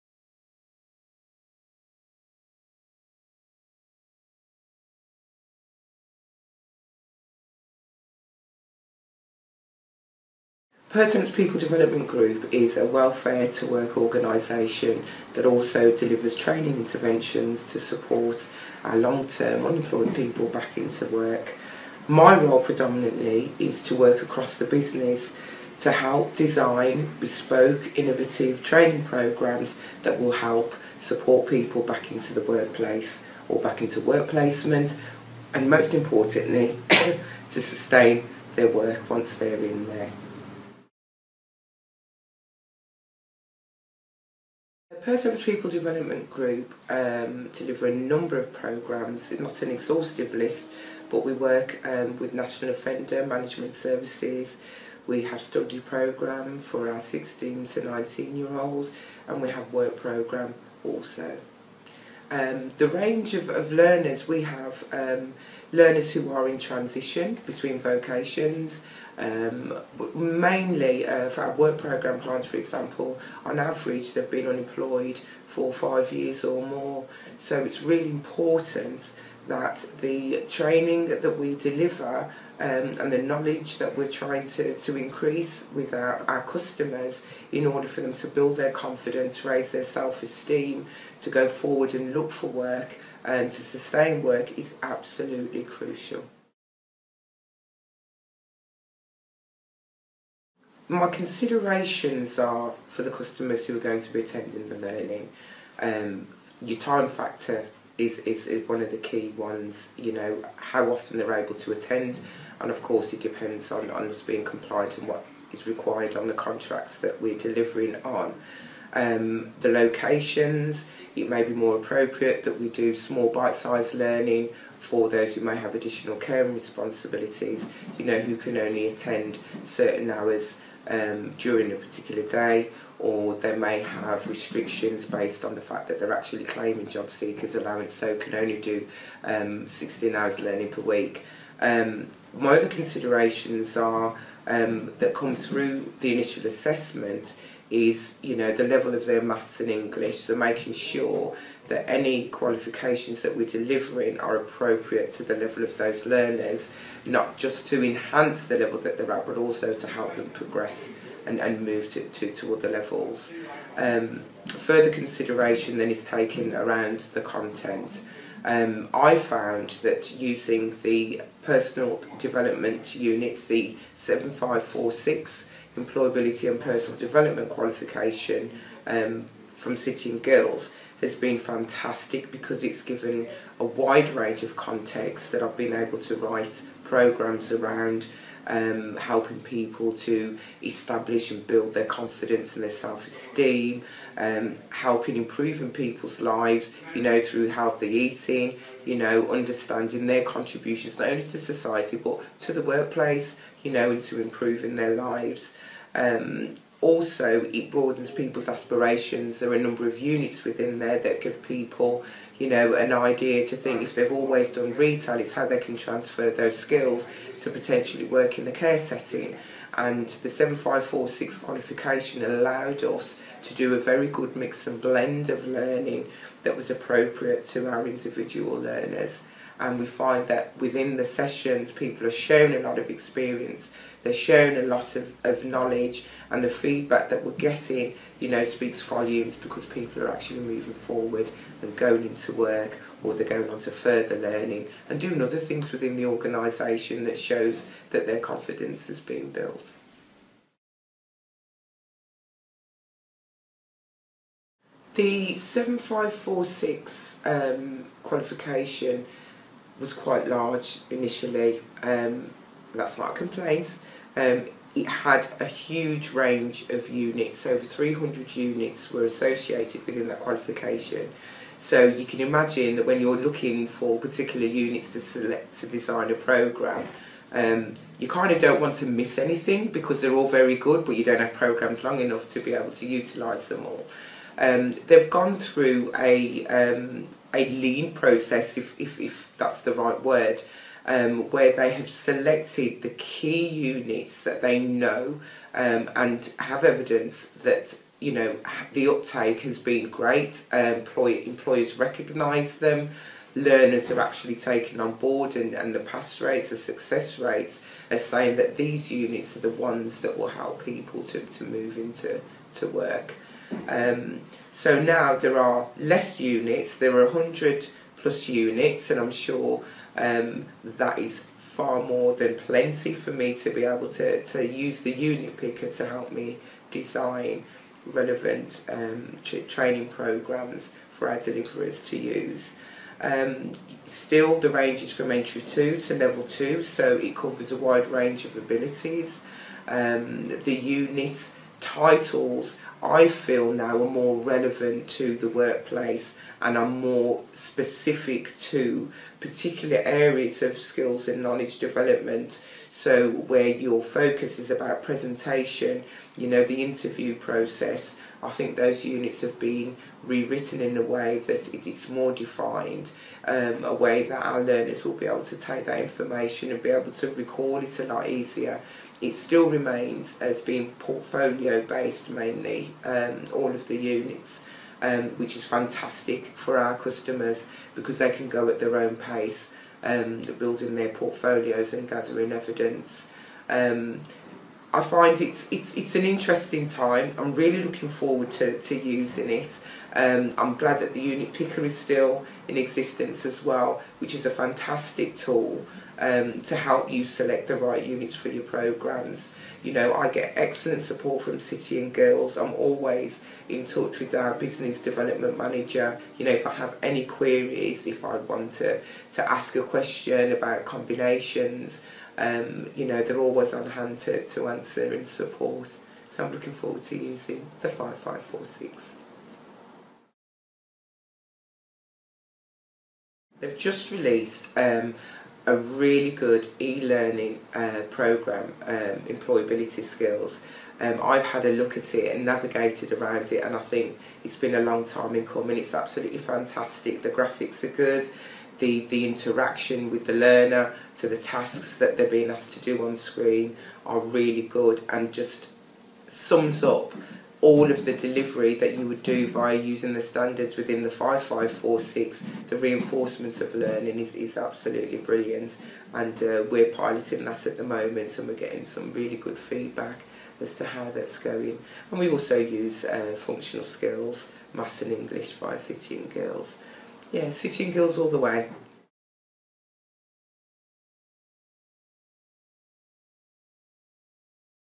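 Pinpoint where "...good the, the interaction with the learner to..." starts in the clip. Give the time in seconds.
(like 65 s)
437 s.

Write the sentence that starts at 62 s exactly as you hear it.
Um, the range of, of learners we have um, learners who are in transition between vocations.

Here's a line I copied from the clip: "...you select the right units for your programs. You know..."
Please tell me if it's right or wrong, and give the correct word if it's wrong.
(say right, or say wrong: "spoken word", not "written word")
right.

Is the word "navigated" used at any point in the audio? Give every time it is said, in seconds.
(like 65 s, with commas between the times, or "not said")
432 s.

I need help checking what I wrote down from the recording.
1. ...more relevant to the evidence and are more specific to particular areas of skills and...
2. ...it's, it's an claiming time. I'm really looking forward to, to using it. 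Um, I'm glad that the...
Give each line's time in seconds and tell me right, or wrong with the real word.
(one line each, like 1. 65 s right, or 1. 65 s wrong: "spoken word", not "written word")
1. 343 s wrong: "workplace", not "evidence"
2. 385 s wrong: "interesting", not "claiming".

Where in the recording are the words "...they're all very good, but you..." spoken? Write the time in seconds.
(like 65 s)
280 s.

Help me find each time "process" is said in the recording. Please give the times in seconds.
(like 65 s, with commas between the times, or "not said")
287 s, 357 s.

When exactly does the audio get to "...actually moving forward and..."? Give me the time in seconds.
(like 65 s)
240 s.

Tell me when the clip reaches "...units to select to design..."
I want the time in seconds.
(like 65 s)
274 s.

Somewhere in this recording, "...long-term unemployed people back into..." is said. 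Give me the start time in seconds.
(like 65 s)
18 s.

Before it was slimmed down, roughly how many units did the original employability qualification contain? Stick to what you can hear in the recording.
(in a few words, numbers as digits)
over 300.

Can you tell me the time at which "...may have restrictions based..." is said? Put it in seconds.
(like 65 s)
133 s.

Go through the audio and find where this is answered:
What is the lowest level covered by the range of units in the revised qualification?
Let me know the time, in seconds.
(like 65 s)
335 s.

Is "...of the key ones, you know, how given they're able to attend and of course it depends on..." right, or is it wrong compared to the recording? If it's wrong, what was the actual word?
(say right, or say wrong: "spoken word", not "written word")
wrong: "often", not "given".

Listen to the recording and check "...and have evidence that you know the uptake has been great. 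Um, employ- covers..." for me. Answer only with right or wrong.
wrong.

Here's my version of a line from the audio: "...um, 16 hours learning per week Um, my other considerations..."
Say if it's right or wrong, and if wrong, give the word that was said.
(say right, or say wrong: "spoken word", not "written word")
right.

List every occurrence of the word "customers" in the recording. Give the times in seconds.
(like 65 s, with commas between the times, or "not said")
86 s, 103 s, 376 s.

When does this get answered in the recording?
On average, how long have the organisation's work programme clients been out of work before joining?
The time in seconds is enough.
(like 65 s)
75 s.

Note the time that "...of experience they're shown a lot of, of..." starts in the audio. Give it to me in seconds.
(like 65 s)
232 s.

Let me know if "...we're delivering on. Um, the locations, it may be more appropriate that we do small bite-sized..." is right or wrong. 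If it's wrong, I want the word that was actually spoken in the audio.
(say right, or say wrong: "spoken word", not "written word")
right.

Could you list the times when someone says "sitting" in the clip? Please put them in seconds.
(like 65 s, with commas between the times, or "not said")
467 s.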